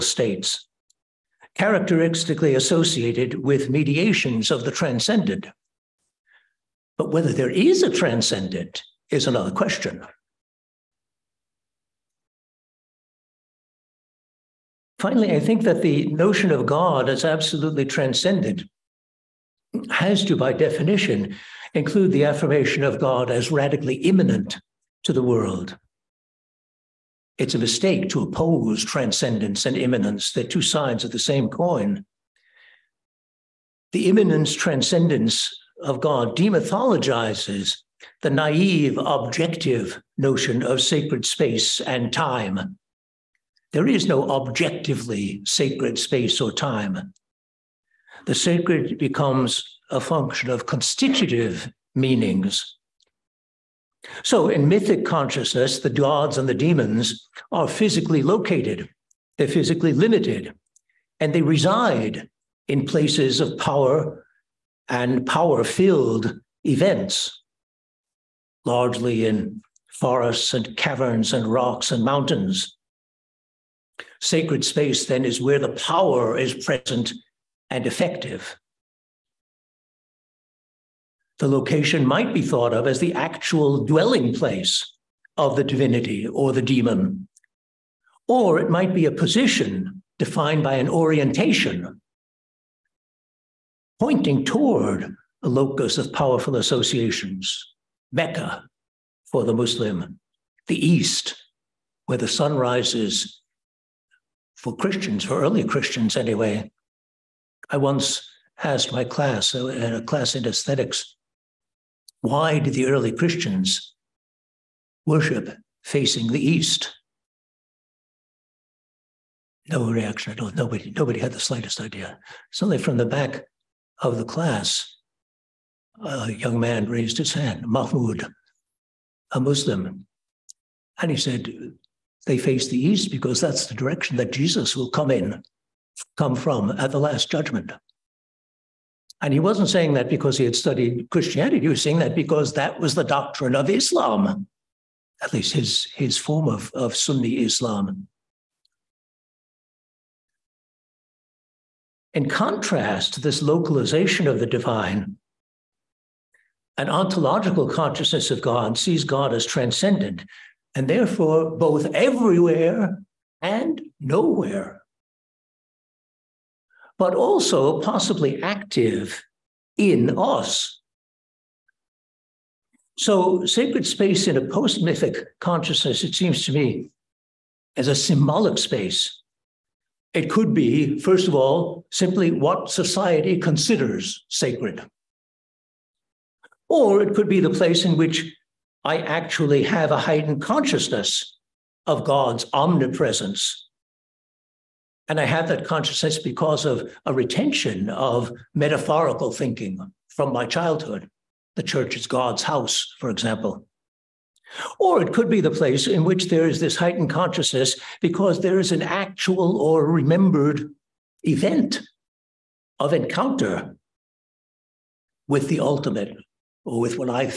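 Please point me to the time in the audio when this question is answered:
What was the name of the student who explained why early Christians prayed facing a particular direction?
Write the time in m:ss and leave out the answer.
2:07.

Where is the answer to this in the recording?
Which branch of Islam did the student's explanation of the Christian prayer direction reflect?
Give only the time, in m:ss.
2:26.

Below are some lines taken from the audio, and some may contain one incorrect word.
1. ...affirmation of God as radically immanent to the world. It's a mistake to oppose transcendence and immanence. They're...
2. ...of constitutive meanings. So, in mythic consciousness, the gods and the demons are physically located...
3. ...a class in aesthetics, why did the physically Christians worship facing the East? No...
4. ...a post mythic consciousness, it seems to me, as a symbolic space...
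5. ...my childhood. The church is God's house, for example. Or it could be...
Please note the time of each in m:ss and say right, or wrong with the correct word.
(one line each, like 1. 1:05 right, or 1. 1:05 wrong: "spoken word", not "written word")
1. 0:22 right
2. 0:50 right
3. 1:49 wrong: "early", not "physically"
4. 2:54 right
5. 3:20 right.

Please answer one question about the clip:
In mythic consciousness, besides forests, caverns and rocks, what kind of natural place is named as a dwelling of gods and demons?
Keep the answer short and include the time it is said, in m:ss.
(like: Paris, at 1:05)
Mountains, at 1:12.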